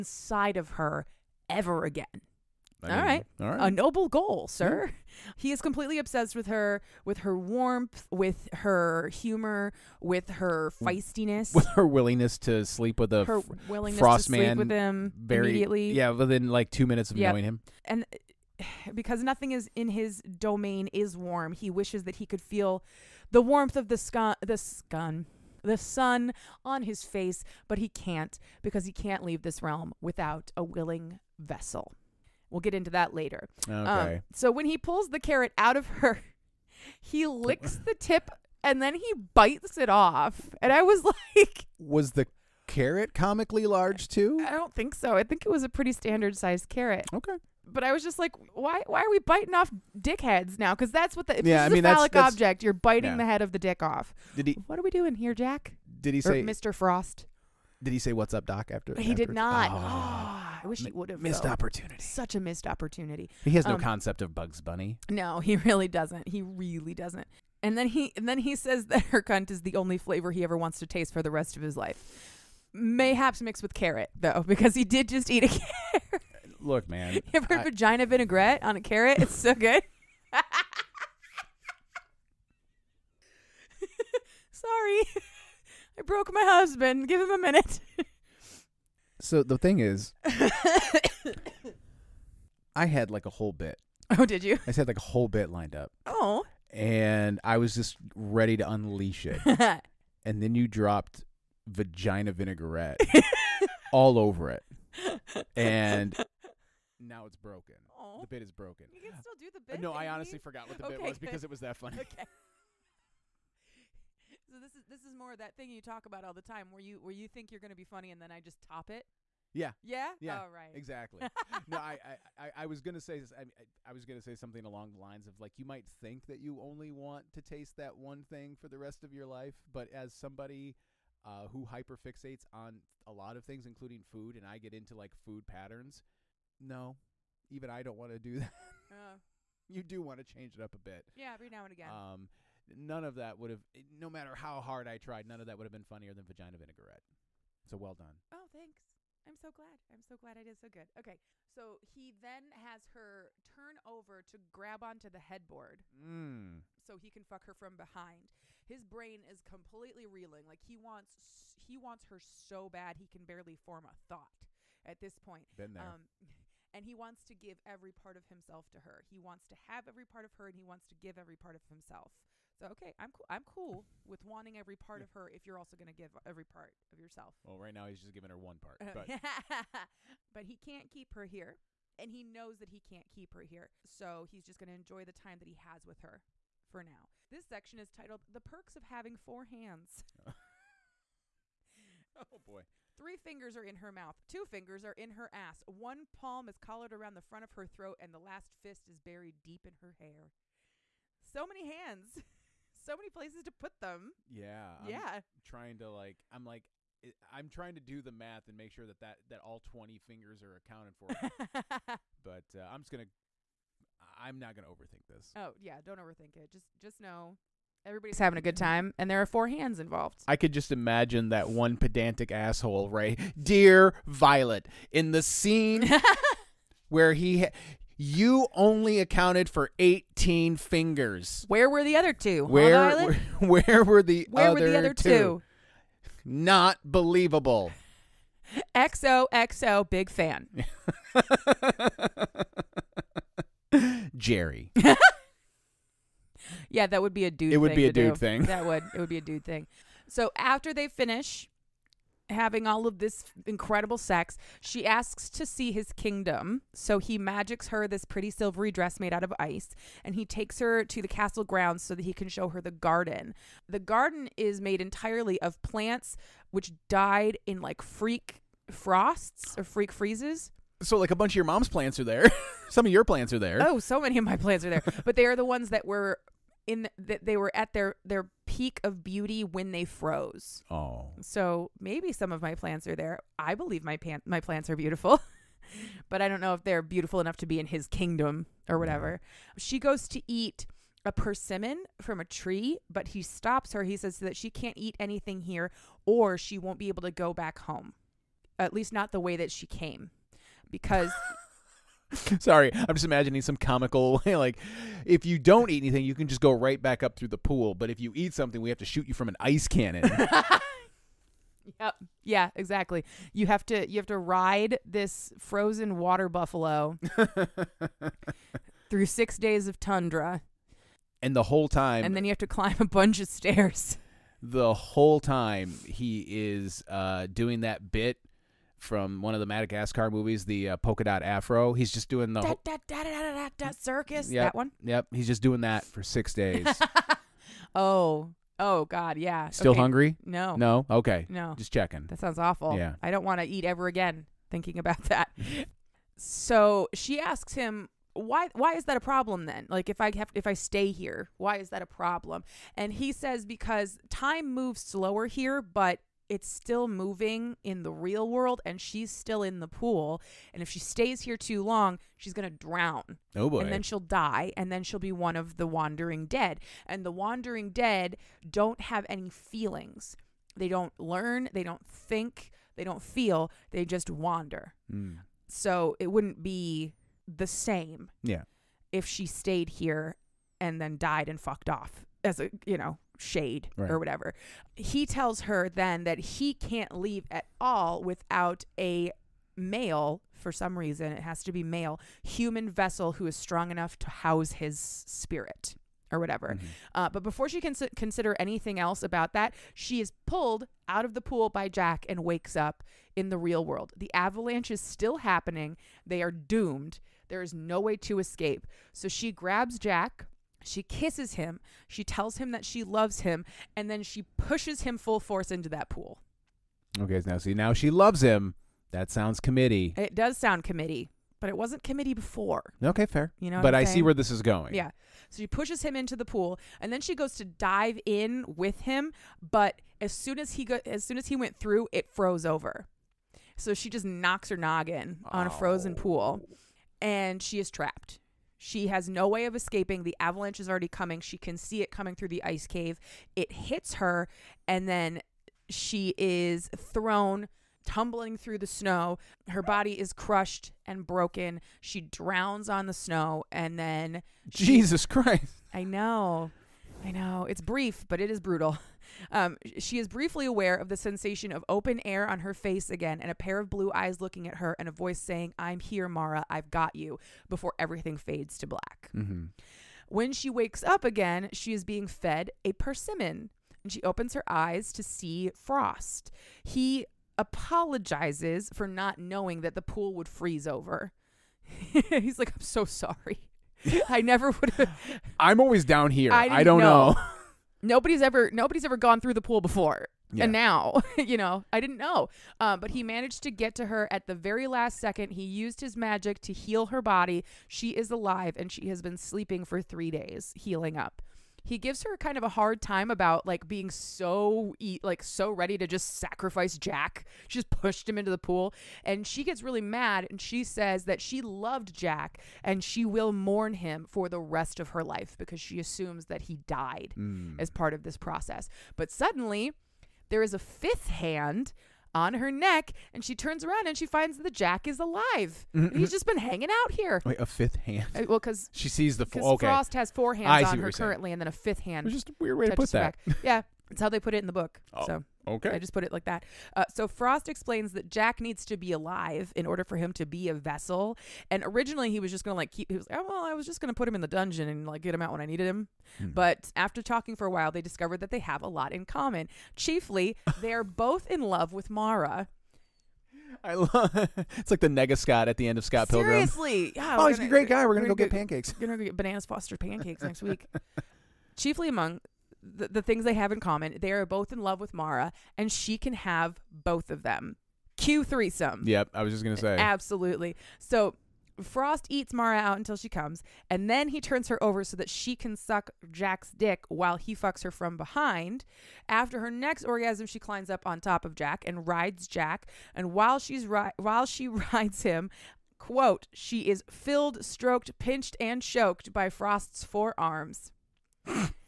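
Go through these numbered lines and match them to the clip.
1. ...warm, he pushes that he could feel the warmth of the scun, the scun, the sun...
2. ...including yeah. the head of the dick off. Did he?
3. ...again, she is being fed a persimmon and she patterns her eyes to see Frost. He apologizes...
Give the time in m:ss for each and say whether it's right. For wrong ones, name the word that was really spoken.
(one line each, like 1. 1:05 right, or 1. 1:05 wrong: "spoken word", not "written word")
1. 0:21 wrong: "wishes", not "pushes"
2. 0:52 wrong: "biting", not "including"
3. 7:51 wrong: "opens", not "patterns".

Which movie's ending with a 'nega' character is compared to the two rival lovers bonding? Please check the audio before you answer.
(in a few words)
Scott Pilgrim.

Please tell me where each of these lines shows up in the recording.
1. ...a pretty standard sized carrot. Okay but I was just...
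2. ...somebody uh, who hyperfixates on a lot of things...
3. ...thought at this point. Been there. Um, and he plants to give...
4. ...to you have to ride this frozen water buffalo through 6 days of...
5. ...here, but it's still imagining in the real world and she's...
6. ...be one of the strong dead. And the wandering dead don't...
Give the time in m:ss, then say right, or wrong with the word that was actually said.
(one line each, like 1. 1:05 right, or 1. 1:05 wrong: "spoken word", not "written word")
1. 0:45 right
2. 2:10 right
3. 2:44 wrong: "wants", not "plants"
4. 5:13 right
5. 5:55 wrong: "moving", not "imagining"
6. 6:04 wrong: "wandering", not "strong".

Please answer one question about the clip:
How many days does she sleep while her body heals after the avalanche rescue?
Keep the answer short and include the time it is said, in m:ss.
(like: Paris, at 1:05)
3, at 8:19.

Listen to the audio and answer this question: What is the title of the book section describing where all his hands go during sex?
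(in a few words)
The Perks of Having Four Hands.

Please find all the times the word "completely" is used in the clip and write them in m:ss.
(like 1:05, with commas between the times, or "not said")
0:05, 2:39.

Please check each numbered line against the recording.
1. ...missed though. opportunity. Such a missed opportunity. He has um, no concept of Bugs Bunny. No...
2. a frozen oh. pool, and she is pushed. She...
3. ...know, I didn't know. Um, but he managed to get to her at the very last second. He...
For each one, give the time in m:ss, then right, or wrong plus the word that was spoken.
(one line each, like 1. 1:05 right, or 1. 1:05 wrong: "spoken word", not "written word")
1. 1:01 right
2. 7:15 wrong: "trapped", not "pushed"
3. 8:11 right.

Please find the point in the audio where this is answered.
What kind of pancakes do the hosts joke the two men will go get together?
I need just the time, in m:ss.
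9:19.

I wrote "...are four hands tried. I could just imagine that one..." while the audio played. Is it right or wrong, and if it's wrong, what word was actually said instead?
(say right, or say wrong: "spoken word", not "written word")
wrong: "involved", not "tried".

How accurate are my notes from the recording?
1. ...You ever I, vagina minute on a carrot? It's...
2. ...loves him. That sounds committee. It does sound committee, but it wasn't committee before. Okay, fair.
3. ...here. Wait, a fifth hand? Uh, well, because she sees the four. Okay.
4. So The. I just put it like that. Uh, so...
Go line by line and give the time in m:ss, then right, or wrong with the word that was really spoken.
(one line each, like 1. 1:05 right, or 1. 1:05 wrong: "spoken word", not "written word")
1. 1:17 wrong: "vinaigrette", not "minute"
2. 6:57 right
3. 8:46 right
4. 8:55 wrong: "Okay", not "The".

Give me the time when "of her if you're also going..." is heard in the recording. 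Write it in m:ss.
2:55.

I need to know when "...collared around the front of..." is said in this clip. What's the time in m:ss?
3:16.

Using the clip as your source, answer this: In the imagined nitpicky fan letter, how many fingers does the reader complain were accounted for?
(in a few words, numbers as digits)
18.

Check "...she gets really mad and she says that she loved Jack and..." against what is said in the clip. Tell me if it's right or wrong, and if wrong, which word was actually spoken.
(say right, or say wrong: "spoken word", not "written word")
right.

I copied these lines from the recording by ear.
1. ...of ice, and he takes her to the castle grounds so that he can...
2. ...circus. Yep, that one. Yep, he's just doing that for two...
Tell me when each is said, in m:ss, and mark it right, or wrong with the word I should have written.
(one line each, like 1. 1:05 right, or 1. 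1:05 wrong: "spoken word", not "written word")
1. 4:19 right
2. 5:33 wrong: "six", not "two".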